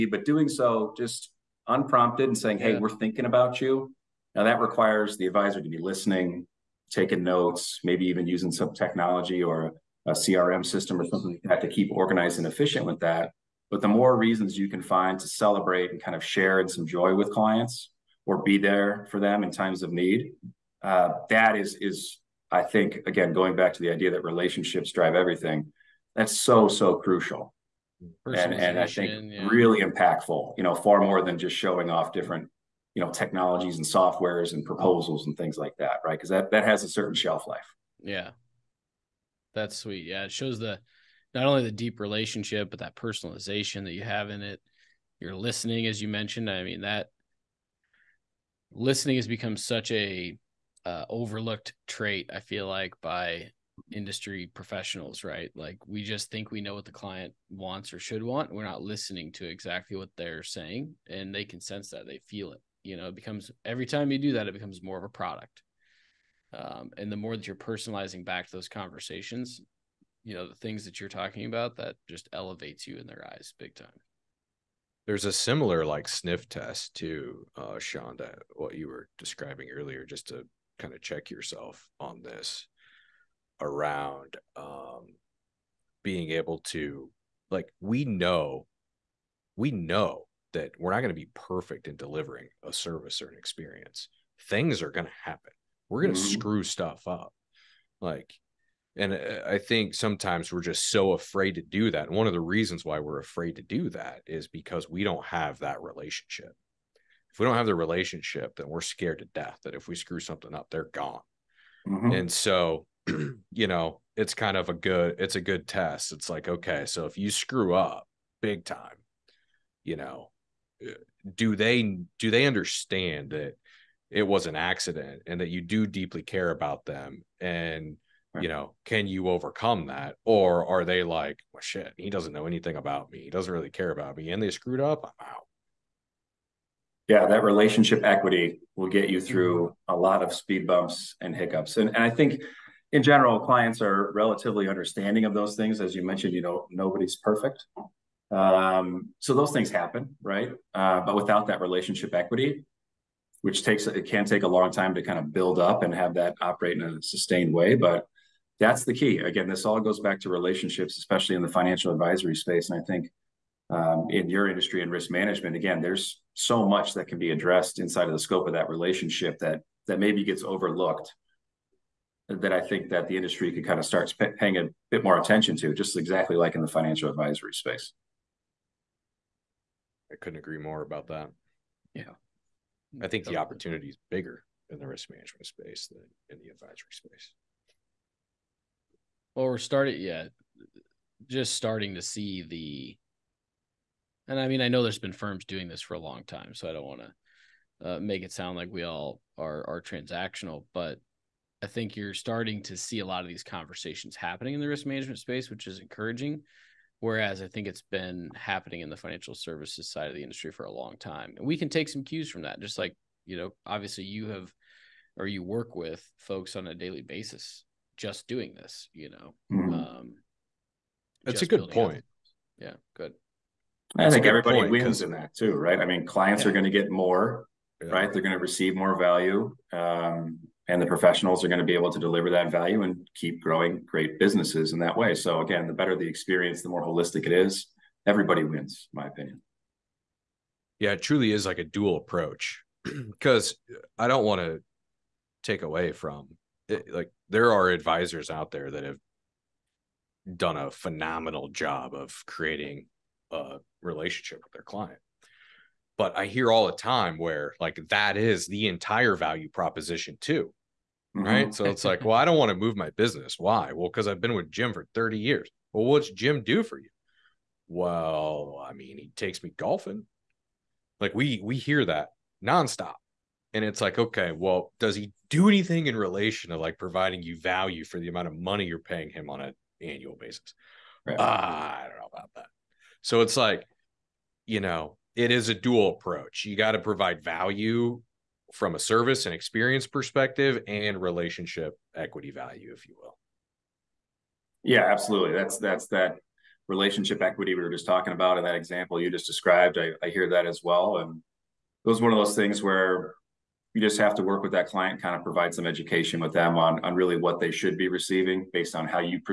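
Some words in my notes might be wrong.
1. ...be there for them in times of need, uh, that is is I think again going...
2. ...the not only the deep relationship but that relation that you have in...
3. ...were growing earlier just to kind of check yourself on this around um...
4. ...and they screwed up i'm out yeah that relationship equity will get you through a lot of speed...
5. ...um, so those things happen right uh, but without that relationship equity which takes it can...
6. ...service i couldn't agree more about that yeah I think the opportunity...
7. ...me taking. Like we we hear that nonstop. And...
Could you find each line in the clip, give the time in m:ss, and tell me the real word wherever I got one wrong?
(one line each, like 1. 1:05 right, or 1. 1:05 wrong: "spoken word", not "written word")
1. 0:18 right
2. 0:40 wrong: "personalization", not "relation"
3. 1:18 wrong: "describing", not "growing"
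4. 2:14 right
5. 2:28 right
6. 2:57 wrong: "space", not "service"
7. 4:29 wrong: "golfing", not "taking".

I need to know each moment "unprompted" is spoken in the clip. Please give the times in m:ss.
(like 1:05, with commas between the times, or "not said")
0:01.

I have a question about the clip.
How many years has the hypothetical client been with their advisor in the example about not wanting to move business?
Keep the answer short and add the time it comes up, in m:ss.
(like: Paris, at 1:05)
30, at 4:24.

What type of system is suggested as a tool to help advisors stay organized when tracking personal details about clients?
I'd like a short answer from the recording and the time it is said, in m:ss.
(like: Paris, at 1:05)
CRM system, at 0:10.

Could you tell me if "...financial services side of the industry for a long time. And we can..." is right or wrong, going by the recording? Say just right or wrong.
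right.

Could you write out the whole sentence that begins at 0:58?
We're not listening to exactly what they're saying, and they can sense that.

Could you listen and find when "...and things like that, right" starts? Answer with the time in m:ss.
0:35.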